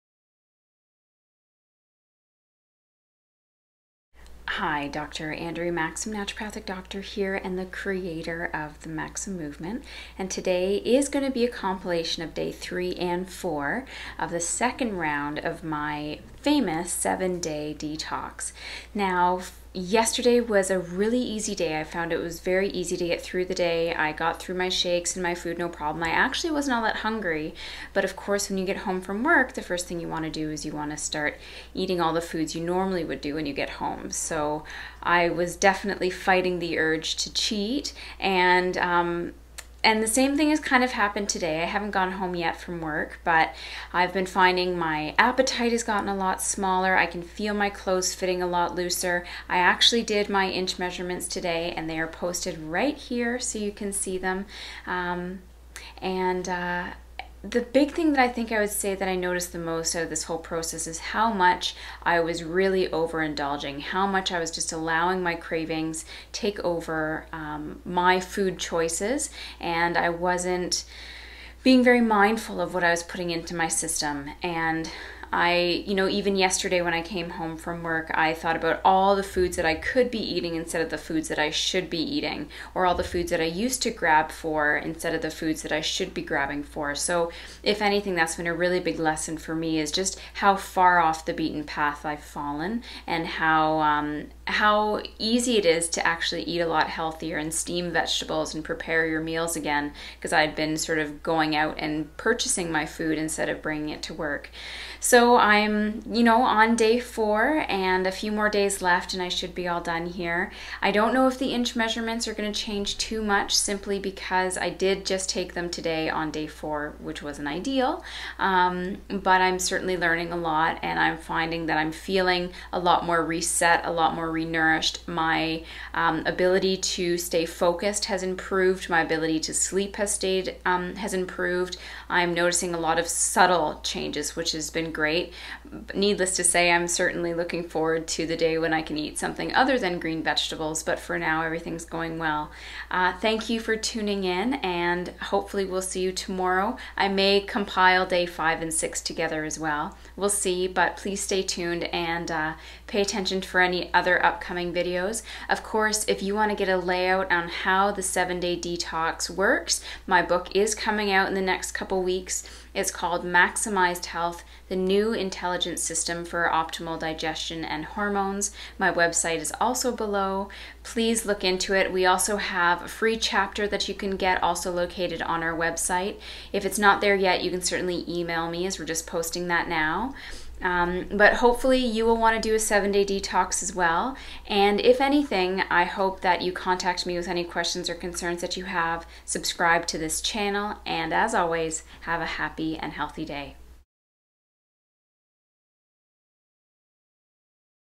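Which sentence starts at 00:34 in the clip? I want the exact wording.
So I was definitely fighting the urge to cheat, and um, and the same thing has kind of happened today.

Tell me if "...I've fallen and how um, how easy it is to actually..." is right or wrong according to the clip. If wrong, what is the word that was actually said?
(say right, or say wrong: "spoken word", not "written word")
right.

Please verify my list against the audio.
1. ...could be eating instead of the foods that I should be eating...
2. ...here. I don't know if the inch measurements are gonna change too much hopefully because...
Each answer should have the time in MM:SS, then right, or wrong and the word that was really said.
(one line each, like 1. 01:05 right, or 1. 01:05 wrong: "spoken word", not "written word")
1. 01:19 right
2. 01:50 wrong: "simply", not "hopefully".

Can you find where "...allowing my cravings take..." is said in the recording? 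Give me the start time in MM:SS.
01:04.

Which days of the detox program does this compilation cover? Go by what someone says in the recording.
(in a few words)
3 and 4.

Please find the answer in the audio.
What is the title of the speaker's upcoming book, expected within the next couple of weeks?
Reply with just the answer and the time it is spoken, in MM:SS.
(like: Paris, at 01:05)
Maximized Health, at 02:43.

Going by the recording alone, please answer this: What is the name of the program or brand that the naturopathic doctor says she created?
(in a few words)
Maxim Movement.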